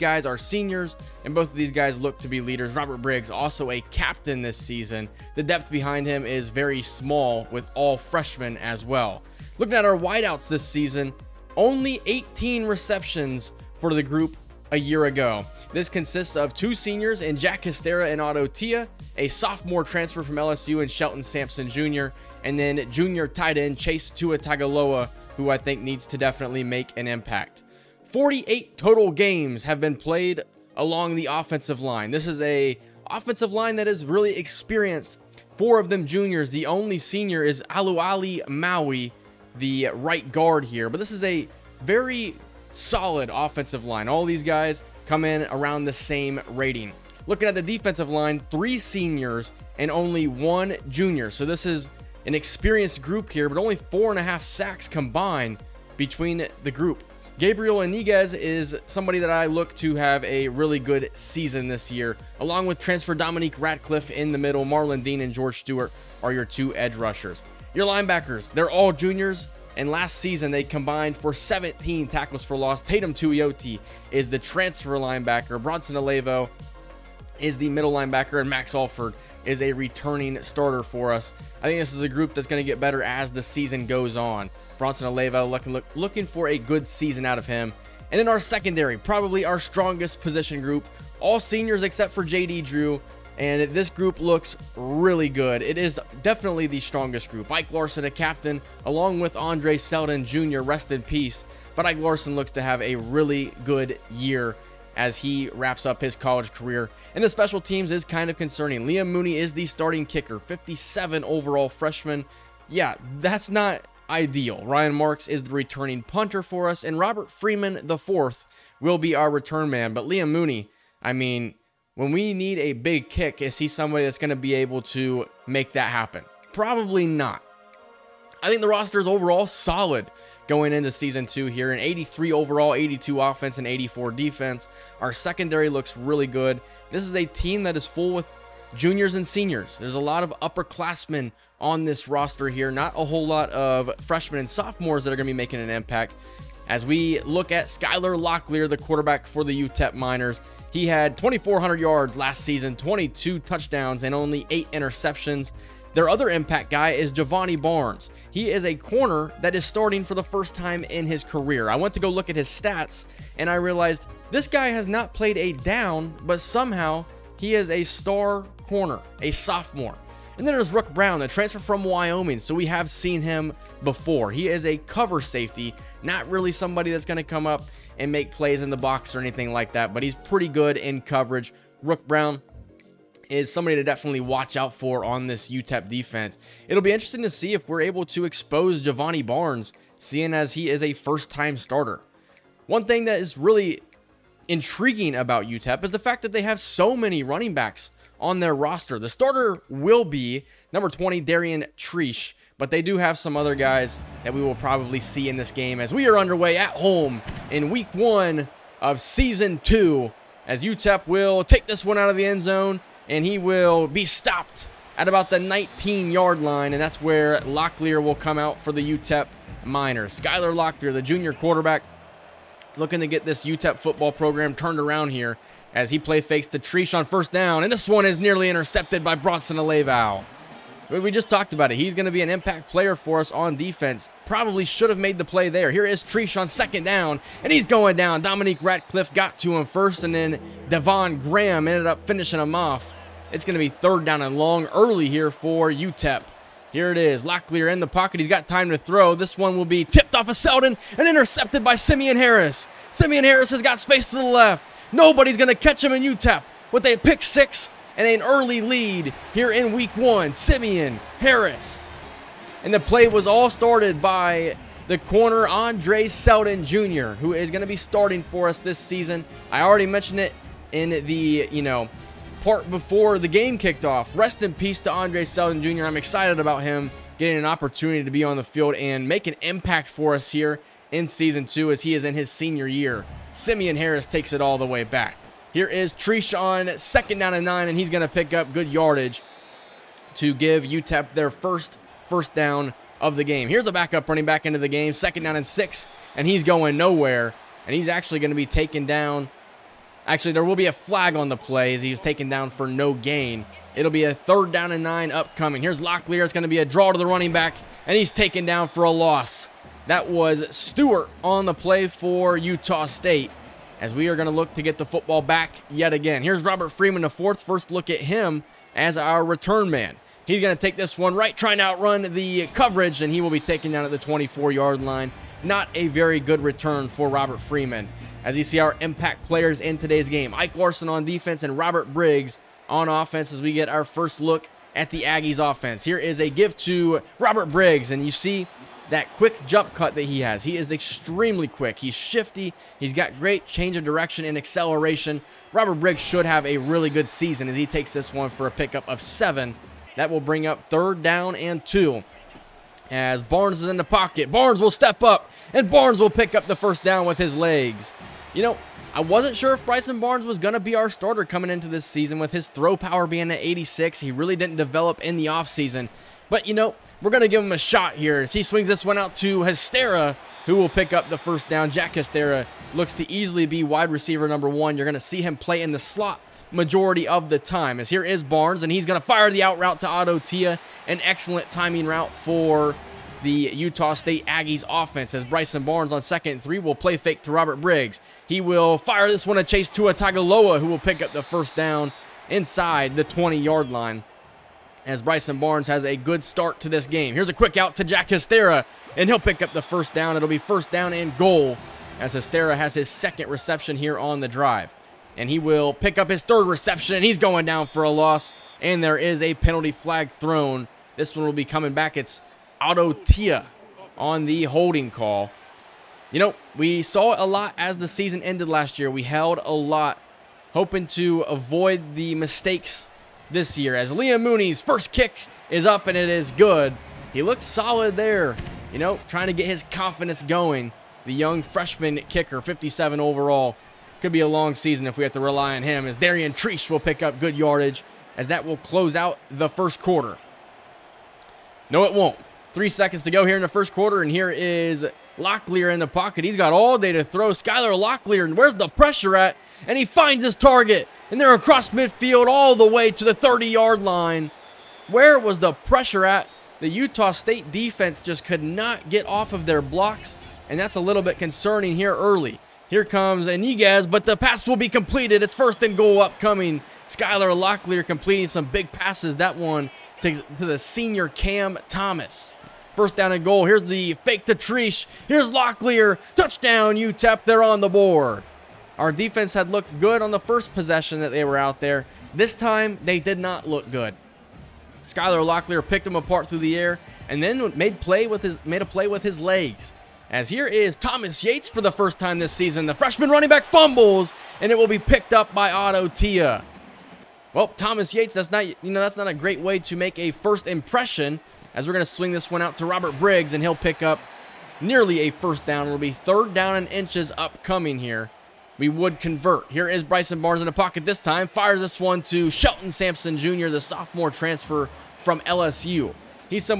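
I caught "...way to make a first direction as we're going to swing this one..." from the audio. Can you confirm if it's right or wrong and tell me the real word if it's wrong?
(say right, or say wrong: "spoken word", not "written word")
wrong: "impression", not "direction".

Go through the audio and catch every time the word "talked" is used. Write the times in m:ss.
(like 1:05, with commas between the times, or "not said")
3:51.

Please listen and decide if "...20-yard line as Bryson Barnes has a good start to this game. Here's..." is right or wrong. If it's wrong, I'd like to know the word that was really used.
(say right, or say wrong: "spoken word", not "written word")
right.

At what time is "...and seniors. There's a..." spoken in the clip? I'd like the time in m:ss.
2:19.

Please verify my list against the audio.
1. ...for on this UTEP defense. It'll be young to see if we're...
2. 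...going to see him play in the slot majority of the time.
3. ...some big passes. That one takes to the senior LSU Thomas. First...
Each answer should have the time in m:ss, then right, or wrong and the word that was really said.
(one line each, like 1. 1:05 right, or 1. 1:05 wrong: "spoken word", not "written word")
1. 3:04 wrong: "interesting", not "young"
2. 6:14 right
3. 7:48 wrong: "Cam", not "LSU".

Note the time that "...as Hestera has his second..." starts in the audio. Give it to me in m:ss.
6:41.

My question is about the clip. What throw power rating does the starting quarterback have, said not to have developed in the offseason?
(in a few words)
86.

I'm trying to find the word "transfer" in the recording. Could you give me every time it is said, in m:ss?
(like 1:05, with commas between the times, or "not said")
0:19, 1:02, 1:14, 2:51, 8:34.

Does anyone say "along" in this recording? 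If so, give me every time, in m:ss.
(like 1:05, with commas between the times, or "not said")
0:30, 1:02, 1:38.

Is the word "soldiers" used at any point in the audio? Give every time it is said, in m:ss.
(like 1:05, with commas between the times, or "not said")
not said.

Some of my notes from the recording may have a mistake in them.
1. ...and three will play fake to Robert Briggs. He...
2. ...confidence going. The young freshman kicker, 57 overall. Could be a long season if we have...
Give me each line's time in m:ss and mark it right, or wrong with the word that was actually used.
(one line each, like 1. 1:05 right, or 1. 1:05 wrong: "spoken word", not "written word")
1. 6:26 right
2. 7:09 right.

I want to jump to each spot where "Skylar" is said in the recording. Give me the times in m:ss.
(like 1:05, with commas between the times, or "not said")
2:27, 3:40, 7:27, 7:46, 8:04.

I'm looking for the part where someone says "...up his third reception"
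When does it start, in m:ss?
6:45.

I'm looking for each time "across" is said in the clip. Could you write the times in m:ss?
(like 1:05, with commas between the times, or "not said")
7:31.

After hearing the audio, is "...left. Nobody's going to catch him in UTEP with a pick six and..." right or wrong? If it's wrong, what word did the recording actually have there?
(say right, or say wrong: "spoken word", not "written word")
right.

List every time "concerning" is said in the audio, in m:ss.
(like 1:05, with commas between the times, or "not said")
1:48, 7:41.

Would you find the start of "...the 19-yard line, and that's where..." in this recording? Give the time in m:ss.
3:35.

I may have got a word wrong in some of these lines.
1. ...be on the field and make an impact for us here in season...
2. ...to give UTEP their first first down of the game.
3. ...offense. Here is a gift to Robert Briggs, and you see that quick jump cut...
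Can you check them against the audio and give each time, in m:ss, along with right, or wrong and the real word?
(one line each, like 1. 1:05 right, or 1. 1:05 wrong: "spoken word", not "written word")
1. 4:38 right
2. 4:50 right
3. 5:35 right.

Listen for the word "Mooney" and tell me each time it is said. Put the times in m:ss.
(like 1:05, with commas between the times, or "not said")
1:49, 2:00, 7:04.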